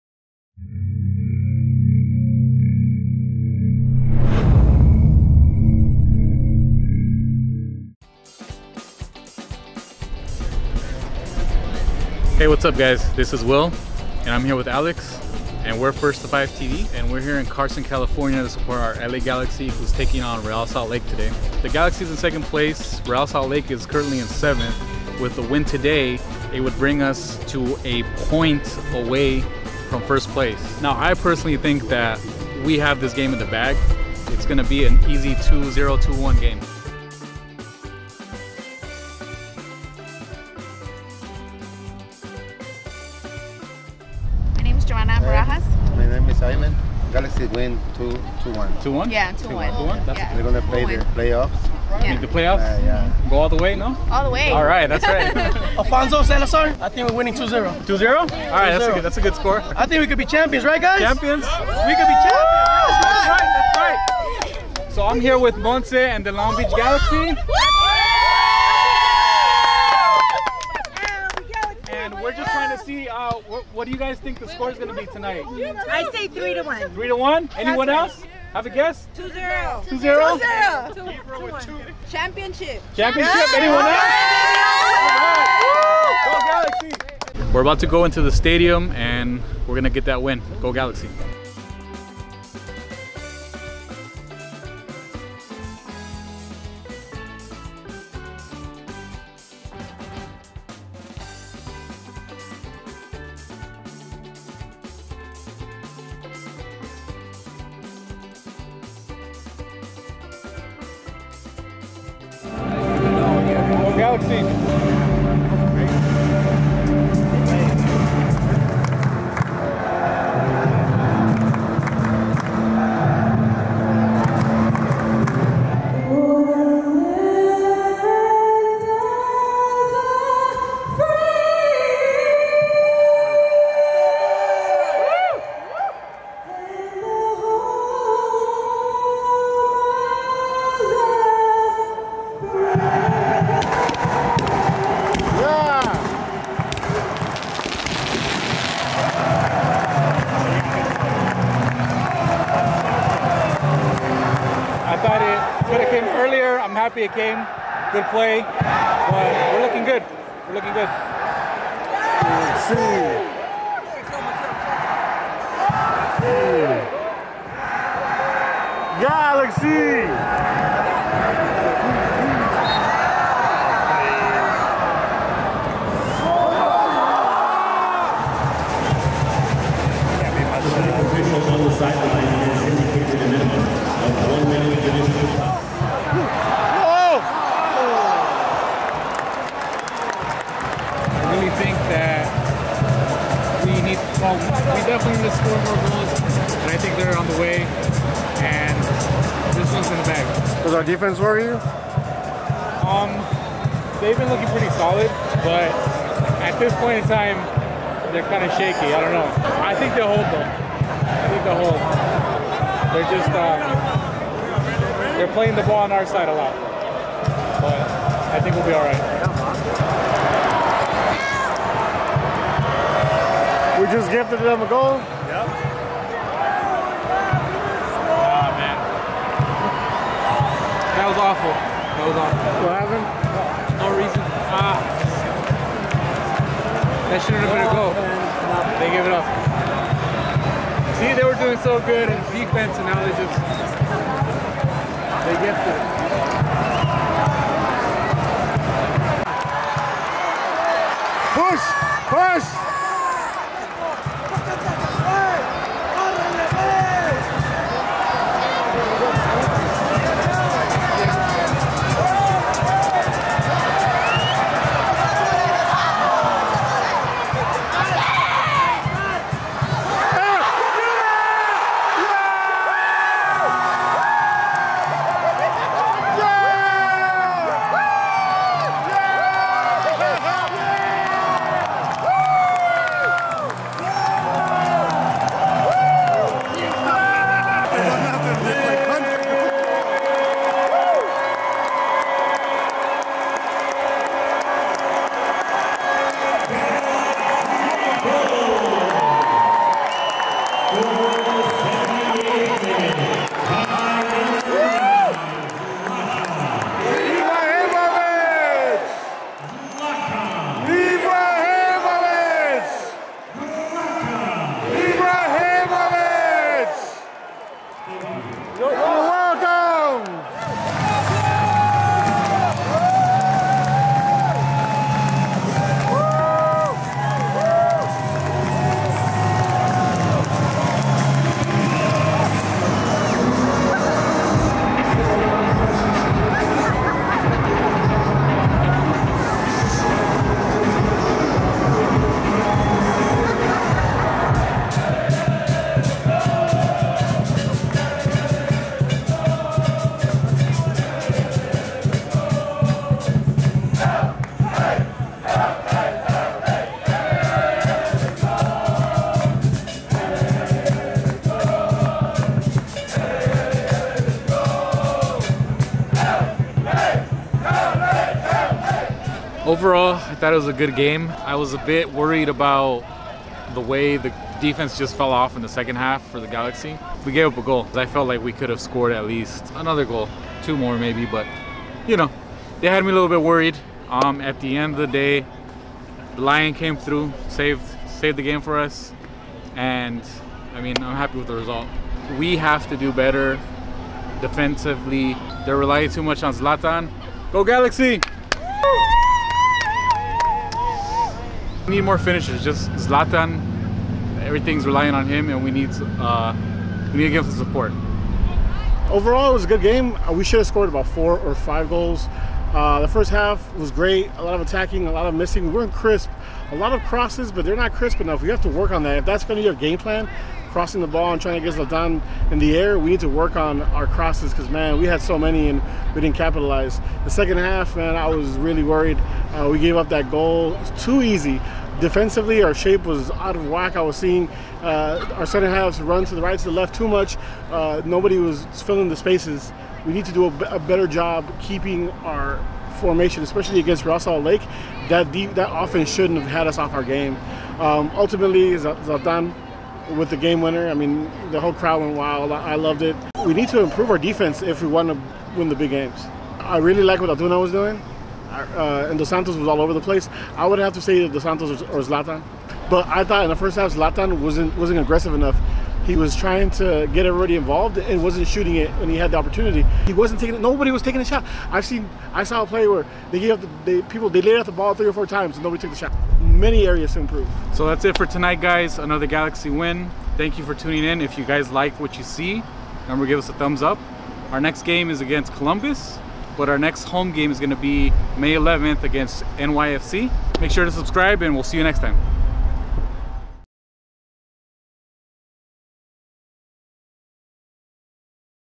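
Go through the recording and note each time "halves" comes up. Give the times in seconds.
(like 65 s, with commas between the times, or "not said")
435 s.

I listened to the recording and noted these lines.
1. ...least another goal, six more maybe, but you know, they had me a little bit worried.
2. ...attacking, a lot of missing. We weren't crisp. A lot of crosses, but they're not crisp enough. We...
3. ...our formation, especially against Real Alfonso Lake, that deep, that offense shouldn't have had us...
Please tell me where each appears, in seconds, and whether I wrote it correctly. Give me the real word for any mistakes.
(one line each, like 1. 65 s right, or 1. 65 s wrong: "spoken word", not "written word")
1. 379 s wrong: "two", not "six"
2. 414 s right
3. 442 s wrong: "Salt", not "Alfonso".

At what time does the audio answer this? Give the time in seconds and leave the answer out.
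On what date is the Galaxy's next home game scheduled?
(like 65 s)
488 s.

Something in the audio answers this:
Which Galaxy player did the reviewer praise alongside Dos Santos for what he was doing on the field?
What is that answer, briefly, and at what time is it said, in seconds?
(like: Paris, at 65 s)
Antuna, at 457 s.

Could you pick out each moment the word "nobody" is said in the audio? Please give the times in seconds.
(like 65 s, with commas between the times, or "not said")
437 s, 470 s, 475 s.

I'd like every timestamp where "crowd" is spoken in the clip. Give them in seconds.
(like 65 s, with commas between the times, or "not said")
451 s.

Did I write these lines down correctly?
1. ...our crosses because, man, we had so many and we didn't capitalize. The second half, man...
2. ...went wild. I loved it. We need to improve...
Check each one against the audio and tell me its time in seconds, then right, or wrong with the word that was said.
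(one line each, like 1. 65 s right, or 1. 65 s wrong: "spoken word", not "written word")
1. 423 s right
2. 451 s right.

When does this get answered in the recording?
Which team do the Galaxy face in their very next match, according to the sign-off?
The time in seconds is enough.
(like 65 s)
485 s.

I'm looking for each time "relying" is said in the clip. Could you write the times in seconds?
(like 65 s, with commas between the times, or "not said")
395 s, 404 s.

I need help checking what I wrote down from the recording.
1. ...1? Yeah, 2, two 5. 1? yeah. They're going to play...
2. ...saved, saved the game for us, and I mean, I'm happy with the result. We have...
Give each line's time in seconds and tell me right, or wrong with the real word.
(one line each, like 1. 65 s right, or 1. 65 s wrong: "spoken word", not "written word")
1. 48 s wrong: "1", not "5"
2. 387 s right.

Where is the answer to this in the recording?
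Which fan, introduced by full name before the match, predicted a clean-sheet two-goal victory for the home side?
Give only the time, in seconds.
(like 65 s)
55 s.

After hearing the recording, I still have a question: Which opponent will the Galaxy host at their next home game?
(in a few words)
NYCFC.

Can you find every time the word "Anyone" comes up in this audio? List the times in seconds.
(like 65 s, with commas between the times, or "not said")
77 s, 83 s.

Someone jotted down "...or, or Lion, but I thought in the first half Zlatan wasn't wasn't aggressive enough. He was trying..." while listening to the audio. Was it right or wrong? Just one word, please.
wrong.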